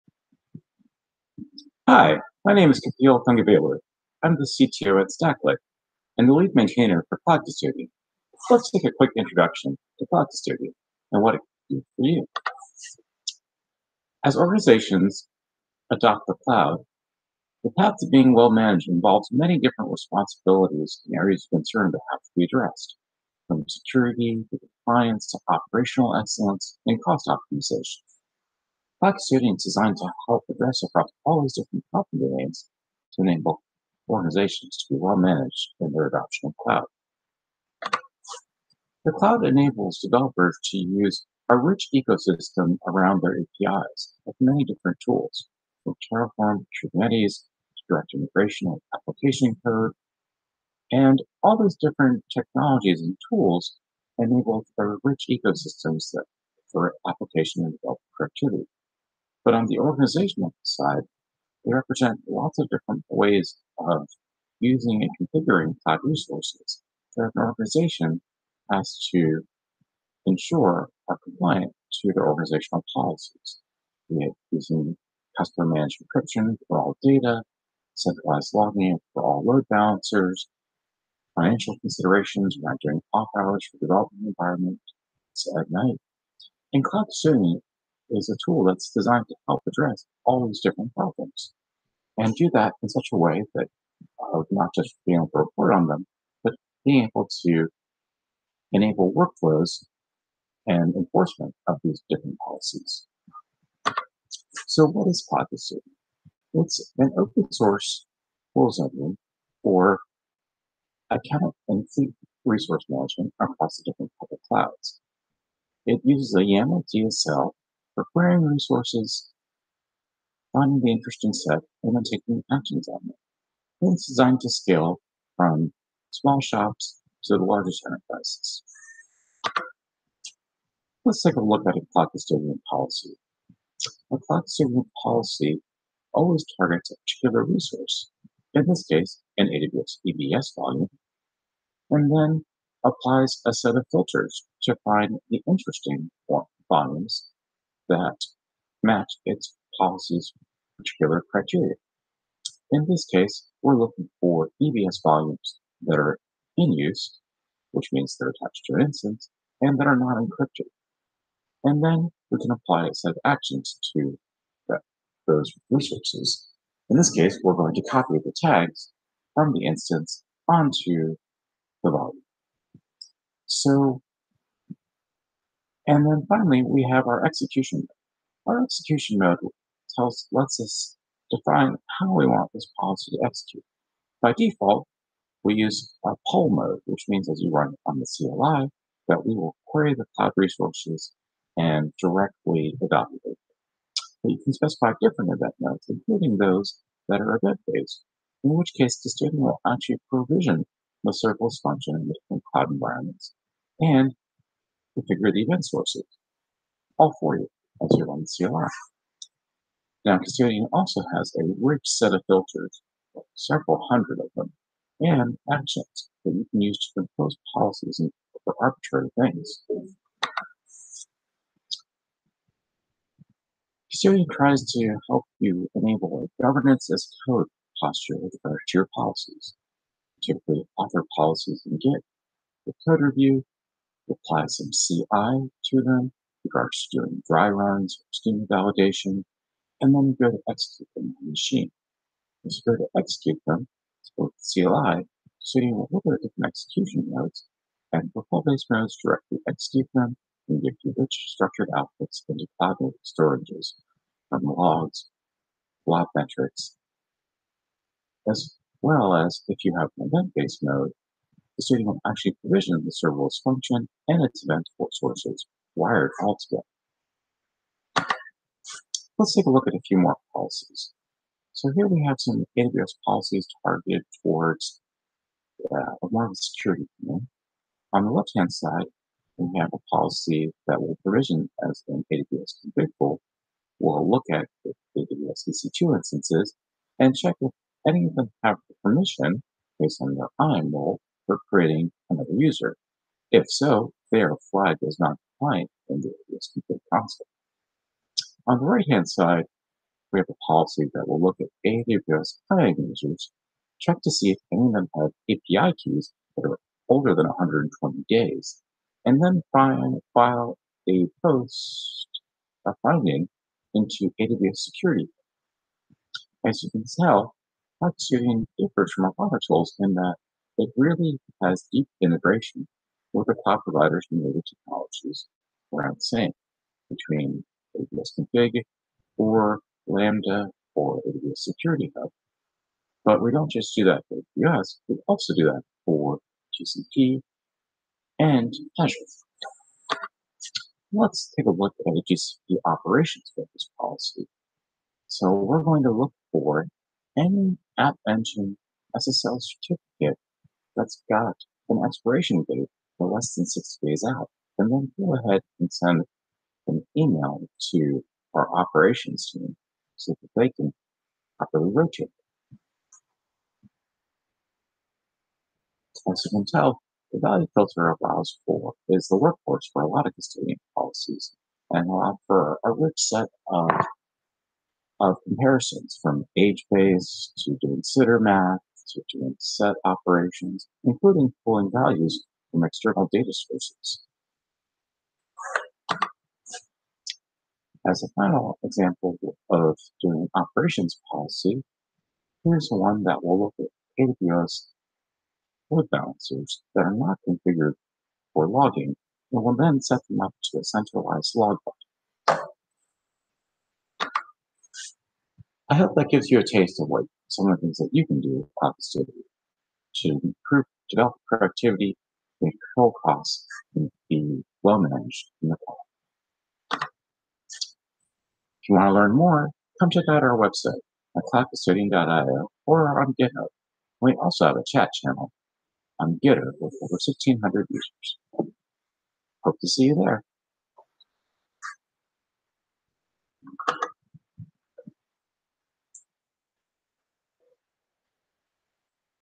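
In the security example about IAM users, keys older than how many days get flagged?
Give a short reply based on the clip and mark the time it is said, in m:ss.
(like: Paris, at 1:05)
120 days, at 5:07.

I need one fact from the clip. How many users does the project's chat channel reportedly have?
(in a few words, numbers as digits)
over 1,600.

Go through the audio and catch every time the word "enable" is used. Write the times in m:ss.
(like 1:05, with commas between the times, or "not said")
0:33, 0:39, 0:54, 1:38, 3:45.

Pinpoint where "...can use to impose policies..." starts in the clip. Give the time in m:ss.
3:36.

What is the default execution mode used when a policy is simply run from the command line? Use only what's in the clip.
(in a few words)
poll mode.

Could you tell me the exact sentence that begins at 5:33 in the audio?
But we don't just do that for AWS, we also do that for GCP and Azure.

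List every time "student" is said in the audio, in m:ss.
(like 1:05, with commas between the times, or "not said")
3:19, 4:21.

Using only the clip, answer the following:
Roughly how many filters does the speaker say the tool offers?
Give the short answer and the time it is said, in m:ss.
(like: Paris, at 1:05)
several hundred, at 3:33.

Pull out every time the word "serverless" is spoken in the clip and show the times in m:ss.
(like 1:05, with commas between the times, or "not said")
3:21, 4:22.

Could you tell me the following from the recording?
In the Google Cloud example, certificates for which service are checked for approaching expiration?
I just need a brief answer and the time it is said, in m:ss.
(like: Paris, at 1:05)
App Engine, at 5:47.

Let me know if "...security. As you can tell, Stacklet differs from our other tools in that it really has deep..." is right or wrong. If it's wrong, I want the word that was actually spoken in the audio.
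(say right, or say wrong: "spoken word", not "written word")
wrong: "Hot", not "Stacklet".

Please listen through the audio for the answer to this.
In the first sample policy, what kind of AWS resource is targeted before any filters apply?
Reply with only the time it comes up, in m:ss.
2:20.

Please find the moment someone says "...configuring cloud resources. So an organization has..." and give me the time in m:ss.
1:05.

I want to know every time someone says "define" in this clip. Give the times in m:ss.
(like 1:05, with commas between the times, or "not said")
3:01.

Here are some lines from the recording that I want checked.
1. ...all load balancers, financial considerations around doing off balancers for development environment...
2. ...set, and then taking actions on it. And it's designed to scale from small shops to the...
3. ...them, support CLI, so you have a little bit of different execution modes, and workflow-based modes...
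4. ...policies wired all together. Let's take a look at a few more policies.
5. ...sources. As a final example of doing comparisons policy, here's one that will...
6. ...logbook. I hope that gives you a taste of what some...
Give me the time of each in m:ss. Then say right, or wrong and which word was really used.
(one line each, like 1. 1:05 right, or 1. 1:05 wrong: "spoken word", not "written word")
1. 1:19 wrong: "hours", not "balancers"
2. 2:01 right
3. 4:03 right
4. 4:24 wrong: "sources", not "policies"
5. 6:23 wrong: "operations", not "comparisons"
6. 6:41 right.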